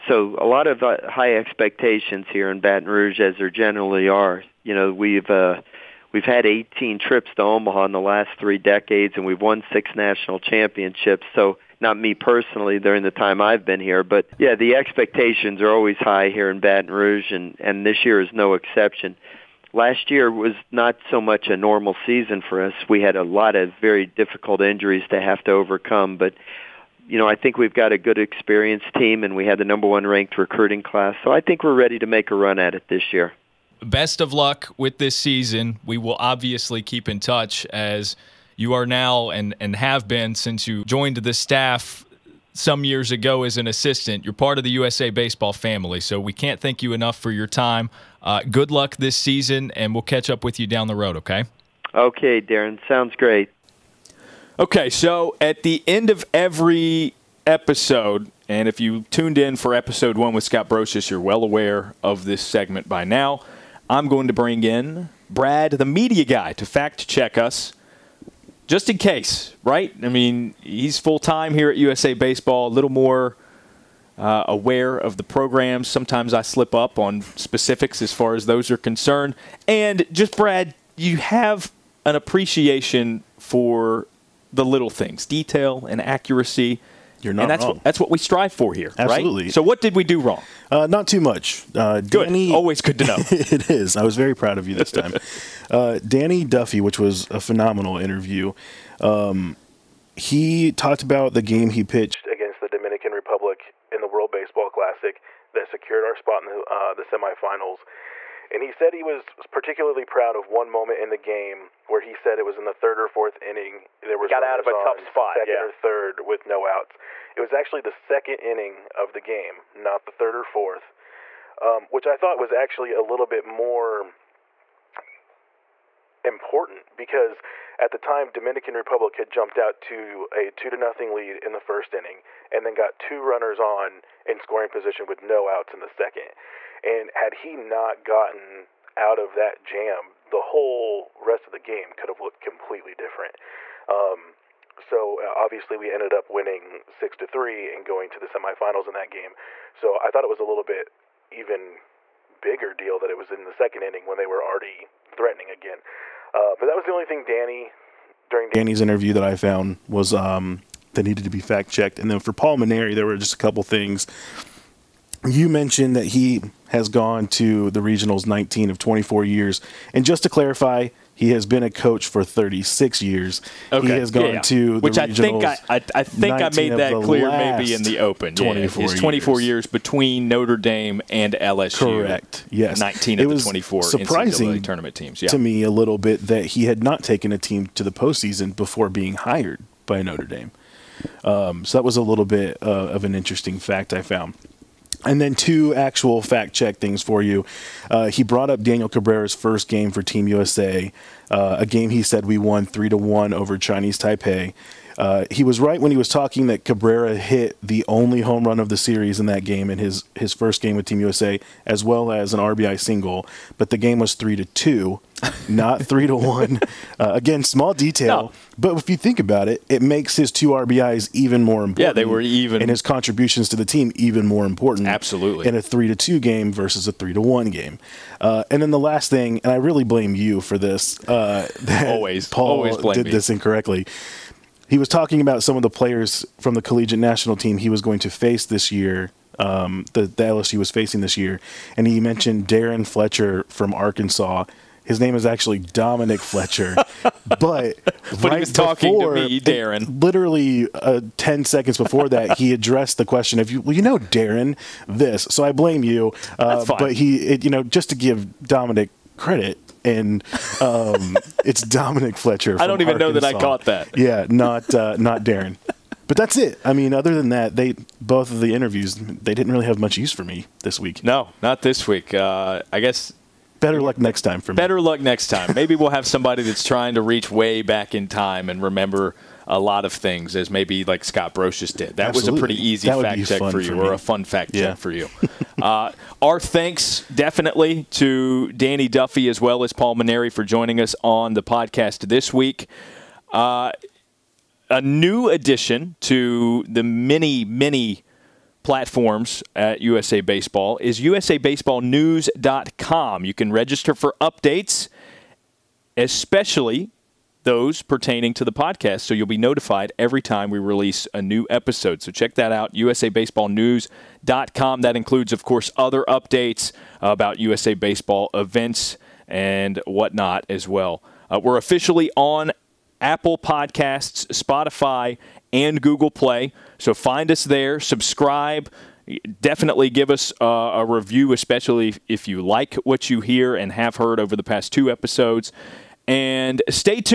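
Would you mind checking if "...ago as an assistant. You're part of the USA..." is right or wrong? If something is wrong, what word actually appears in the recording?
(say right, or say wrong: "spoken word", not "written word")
right.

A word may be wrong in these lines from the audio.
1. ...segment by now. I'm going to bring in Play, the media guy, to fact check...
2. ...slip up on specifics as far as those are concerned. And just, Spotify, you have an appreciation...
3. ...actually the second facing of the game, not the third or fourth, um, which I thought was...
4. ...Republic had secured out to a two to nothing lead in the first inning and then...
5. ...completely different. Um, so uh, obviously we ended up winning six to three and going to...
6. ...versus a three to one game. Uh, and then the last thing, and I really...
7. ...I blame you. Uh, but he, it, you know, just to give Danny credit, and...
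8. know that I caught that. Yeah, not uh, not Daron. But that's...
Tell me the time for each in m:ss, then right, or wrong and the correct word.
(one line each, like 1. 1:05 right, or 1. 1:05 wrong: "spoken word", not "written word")
1. 1:02 wrong: "Brad", not "Play"
2. 1:16 wrong: "Brad", not "Spotify"
3. 1:57 wrong: "inning", not "facing"
4. 2:08 wrong: "jumped", not "secured"
5. 2:22 right
6. 3:46 right
7. 4:15 wrong: "Dominic", not "Danny"
8. 4:23 right.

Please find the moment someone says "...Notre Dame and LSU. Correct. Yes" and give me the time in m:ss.
3:00.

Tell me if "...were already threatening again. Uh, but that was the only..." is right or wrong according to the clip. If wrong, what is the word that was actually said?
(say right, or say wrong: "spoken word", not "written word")
right.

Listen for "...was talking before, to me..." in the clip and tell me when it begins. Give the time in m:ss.
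4:08.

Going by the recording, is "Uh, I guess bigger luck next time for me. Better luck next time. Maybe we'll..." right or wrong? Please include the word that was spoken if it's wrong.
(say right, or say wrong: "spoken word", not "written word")
wrong: "better", not "bigger".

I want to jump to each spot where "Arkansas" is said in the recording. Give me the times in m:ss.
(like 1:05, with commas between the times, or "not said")
4:03, 4:23.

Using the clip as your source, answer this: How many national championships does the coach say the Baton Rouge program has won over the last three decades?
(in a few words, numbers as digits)
6.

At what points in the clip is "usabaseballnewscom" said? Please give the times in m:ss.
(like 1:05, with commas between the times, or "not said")
5:00, 5:12.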